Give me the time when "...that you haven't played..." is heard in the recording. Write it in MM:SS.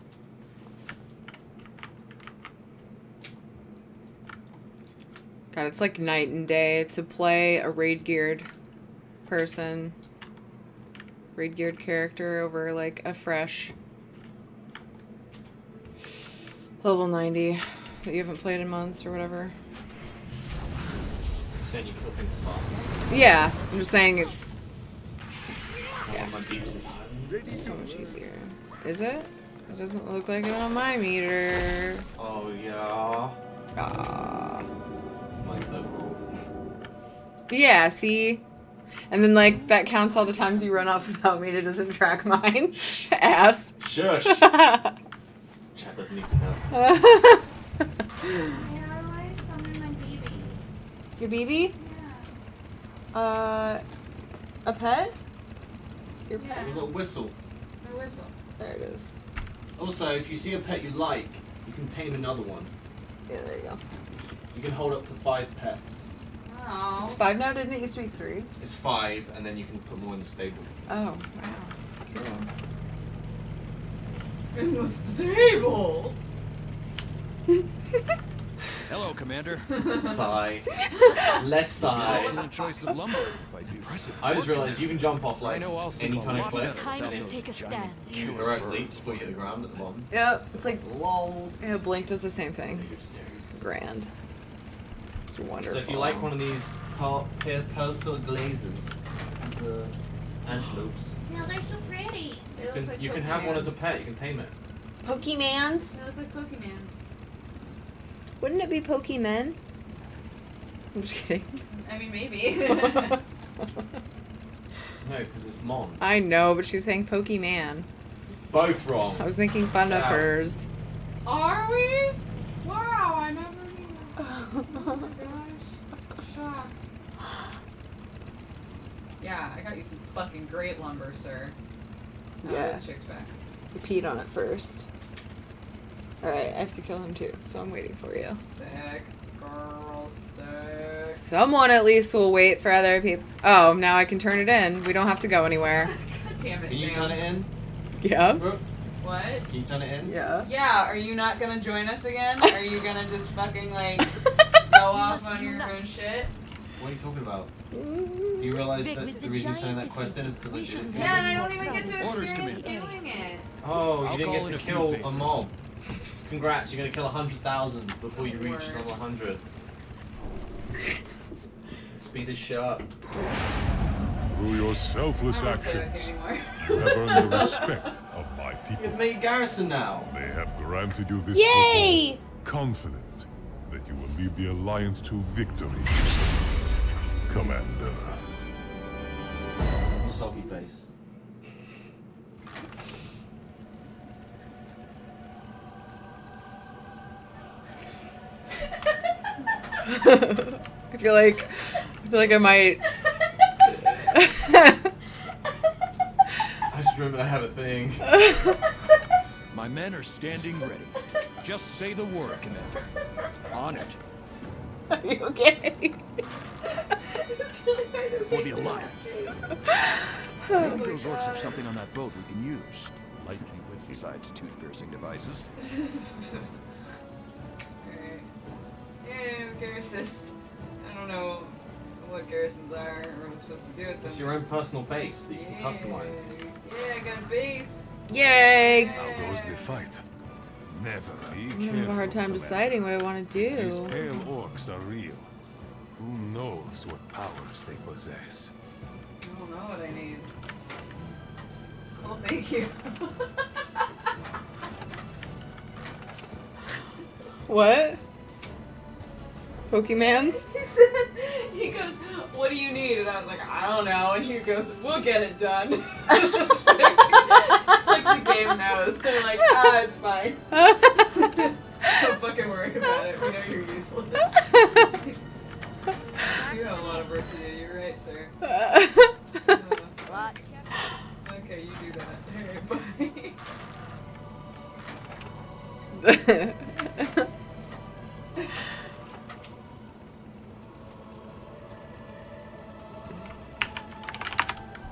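00:18.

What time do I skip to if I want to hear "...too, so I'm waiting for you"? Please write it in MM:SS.
02:17.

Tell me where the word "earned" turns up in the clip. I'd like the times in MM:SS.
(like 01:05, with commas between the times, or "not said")
02:56.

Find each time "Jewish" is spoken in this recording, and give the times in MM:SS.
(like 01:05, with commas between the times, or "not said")
not said.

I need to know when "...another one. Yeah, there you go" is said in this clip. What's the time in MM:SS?
01:02.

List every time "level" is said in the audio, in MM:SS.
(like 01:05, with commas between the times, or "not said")
00:16, 02:48.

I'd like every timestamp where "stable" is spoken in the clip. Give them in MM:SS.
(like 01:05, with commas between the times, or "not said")
01:10, 01:15.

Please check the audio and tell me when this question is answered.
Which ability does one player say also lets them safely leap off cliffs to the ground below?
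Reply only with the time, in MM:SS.
01:31.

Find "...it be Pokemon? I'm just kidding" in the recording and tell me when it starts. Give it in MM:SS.
01:48.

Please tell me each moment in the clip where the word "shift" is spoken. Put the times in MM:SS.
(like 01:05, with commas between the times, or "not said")
not said.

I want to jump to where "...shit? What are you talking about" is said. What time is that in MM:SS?
02:35.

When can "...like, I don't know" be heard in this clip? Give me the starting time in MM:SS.
04:23.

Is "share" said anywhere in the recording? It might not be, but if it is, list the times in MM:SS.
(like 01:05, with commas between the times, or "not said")
not said.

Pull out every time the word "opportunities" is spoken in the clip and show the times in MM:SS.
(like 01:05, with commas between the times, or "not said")
not said.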